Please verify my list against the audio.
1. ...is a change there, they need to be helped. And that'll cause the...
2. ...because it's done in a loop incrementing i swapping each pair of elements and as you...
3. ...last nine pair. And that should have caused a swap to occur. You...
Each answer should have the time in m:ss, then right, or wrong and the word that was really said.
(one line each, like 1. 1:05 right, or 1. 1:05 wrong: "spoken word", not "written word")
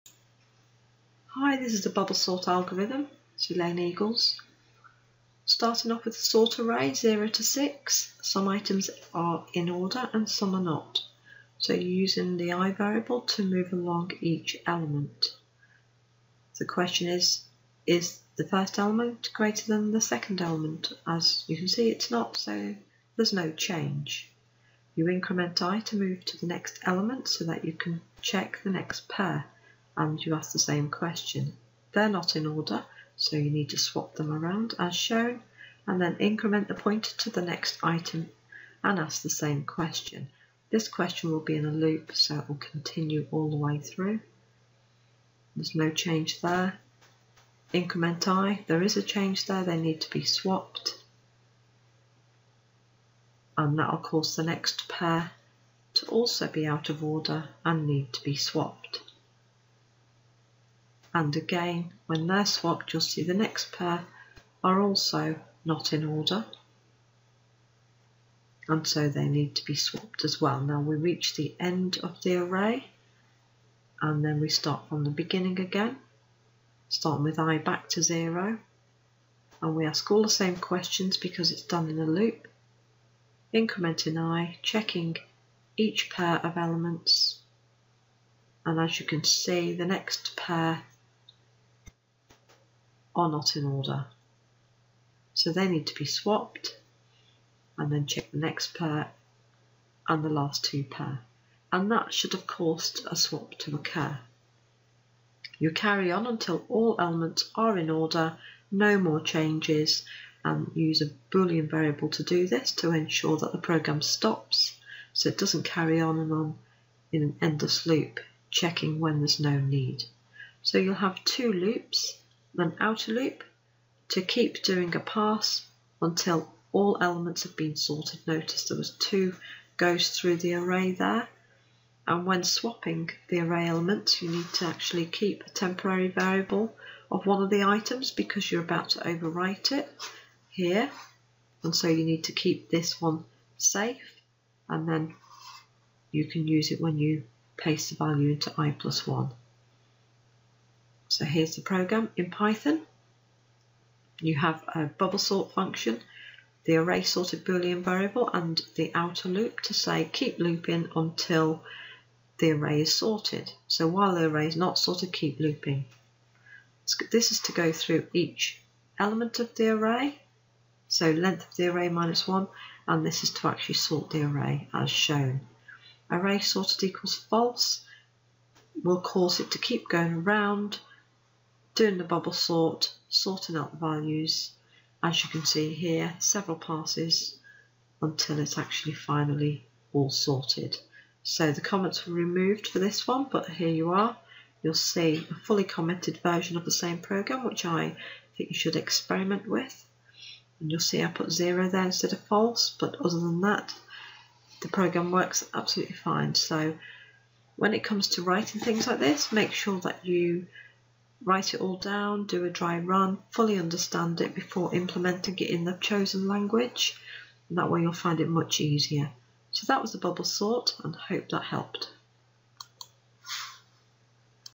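1. 0:48 wrong: "swapped", not "helped"
2. 1:21 wrong: "checking", not "swapping"
3. 1:40 wrong: "two", not "nine".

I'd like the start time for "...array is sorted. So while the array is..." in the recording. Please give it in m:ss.
2:42.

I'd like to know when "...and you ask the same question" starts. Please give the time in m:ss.
0:30.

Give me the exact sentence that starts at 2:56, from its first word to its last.
Array sorted equals false will cause it to keep going around doing the bubble sort, sorting out the values.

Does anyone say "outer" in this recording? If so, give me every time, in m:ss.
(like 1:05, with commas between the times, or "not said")
2:02, 2:38.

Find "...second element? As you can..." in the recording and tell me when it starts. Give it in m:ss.
0:20.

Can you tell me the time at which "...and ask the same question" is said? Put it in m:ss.
0:38.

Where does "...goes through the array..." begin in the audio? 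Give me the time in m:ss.
2:09.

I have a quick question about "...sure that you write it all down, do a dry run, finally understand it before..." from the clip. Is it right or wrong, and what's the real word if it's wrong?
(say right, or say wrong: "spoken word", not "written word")
wrong: "fully", not "finally".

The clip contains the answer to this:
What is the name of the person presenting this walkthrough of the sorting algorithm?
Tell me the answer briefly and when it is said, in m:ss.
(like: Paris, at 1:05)
Elaine Eagles, at 0:03.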